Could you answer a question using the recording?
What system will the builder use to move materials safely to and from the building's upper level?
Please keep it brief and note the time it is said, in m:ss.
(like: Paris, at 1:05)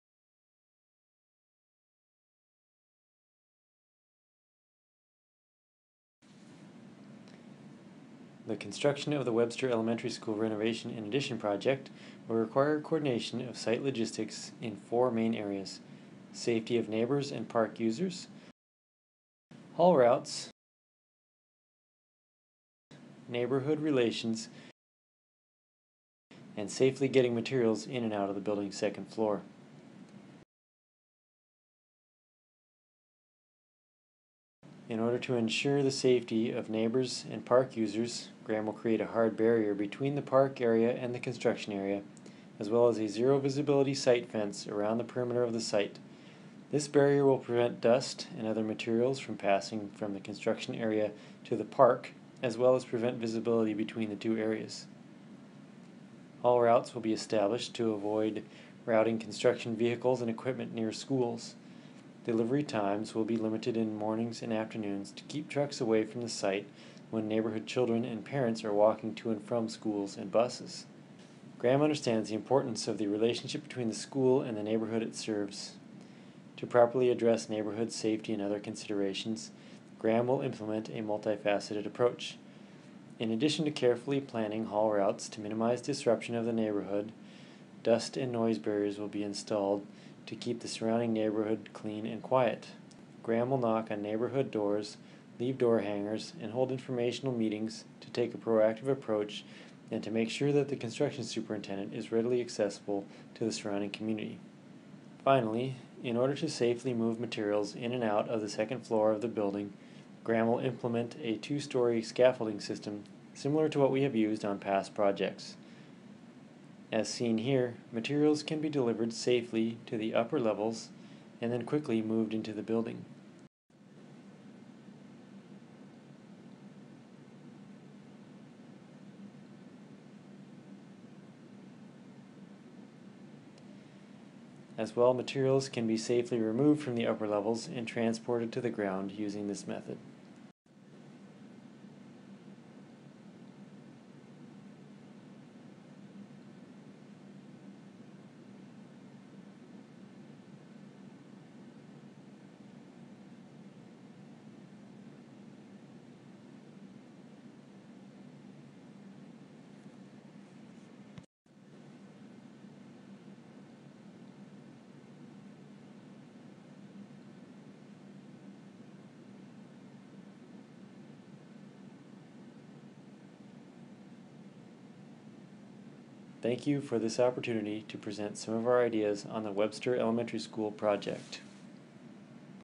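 two story scaffolding system, at 1:51.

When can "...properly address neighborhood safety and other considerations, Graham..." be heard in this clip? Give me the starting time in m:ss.
1:16.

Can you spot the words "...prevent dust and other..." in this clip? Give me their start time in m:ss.
0:47.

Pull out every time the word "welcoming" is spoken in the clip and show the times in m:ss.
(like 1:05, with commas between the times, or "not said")
not said.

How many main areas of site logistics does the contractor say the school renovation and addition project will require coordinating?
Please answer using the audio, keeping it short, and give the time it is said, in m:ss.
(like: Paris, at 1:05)
4, at 0:14.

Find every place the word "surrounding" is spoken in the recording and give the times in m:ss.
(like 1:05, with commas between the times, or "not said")
1:30, 1:43.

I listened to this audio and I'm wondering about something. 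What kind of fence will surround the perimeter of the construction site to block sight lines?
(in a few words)
zero visibility site fence.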